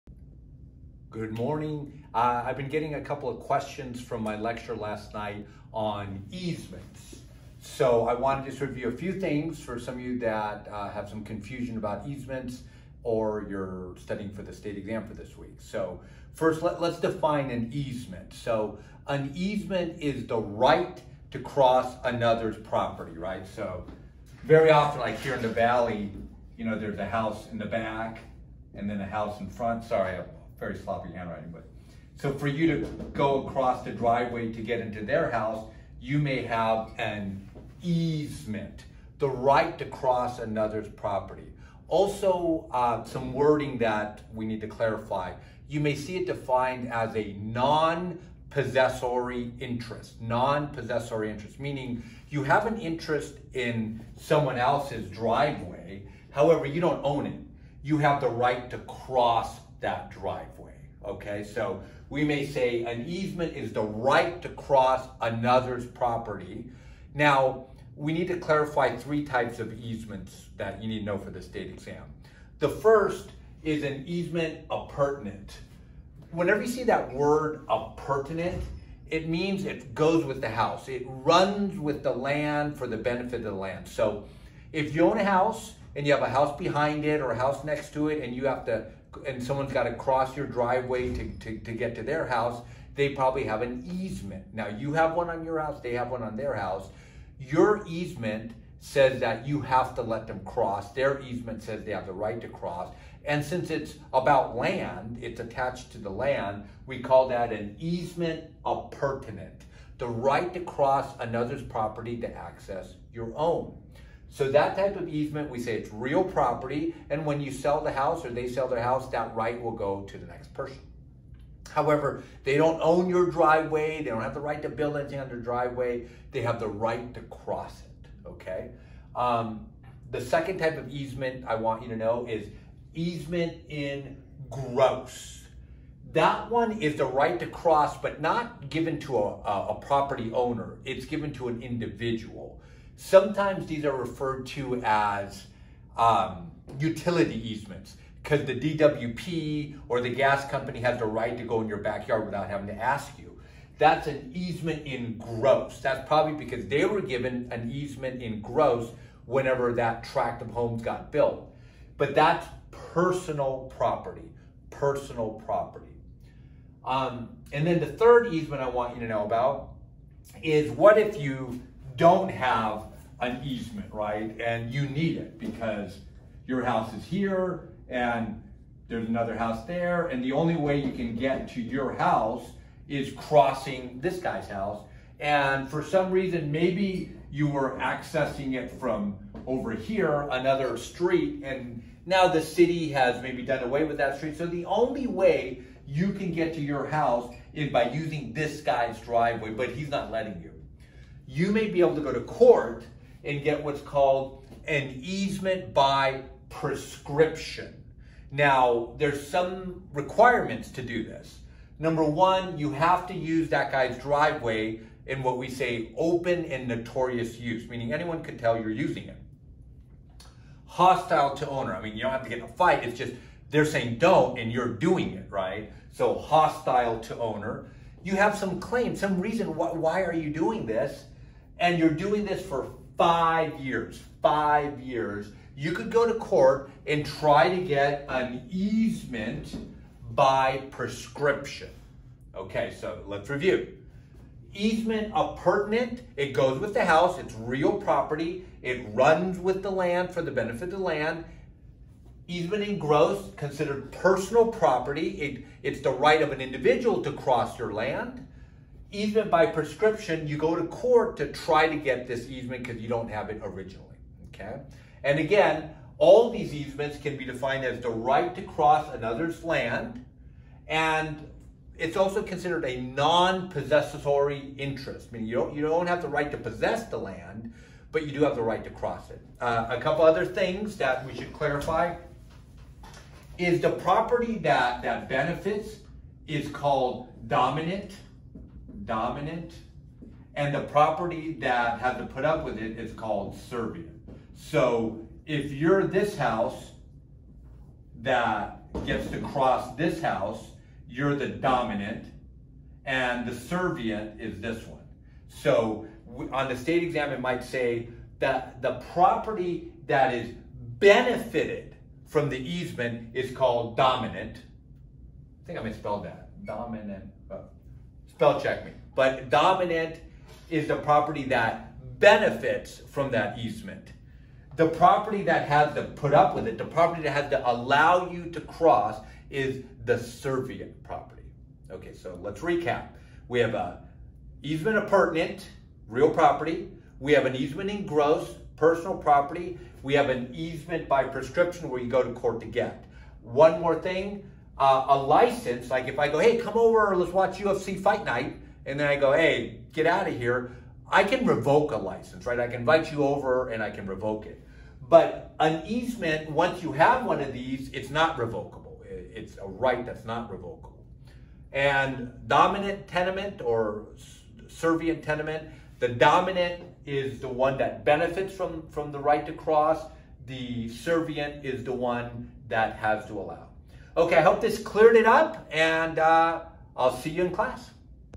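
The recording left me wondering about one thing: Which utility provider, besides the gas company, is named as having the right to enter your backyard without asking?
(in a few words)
DWP.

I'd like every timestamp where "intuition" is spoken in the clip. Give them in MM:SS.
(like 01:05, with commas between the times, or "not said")
not said.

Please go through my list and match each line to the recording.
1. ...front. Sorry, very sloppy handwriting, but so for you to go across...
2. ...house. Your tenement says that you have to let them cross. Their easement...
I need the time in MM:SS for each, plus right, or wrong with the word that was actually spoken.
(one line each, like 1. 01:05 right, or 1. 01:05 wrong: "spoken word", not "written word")
1. 00:29 right
2. 01:36 wrong: "easement", not "tenement".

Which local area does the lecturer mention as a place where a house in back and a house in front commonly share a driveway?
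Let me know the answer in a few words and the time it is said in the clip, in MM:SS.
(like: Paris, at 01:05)
the valley, at 00:25.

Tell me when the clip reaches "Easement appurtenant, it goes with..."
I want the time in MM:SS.
04:04.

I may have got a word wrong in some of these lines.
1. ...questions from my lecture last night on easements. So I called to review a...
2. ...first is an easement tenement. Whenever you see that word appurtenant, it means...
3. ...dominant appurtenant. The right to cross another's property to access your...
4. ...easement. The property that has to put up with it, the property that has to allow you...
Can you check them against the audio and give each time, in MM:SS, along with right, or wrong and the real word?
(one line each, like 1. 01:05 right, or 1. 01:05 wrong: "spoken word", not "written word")
1. 00:03 wrong: "wanted", not "called"
2. 01:12 wrong: "appurtenant", not "tenement"
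3. 01:47 wrong: "easement", not "dominant"
4. 05:23 right.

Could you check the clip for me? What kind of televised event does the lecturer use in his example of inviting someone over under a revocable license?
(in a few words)
UFC fight night.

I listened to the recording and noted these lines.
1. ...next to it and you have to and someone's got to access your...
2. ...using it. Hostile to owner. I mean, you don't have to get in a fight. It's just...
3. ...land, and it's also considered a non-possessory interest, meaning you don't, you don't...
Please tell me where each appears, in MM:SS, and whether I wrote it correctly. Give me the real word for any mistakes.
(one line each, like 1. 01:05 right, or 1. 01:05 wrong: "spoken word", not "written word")
1. 01:27 wrong: "cross", not "access"
2. 03:38 right
3. 04:29 right.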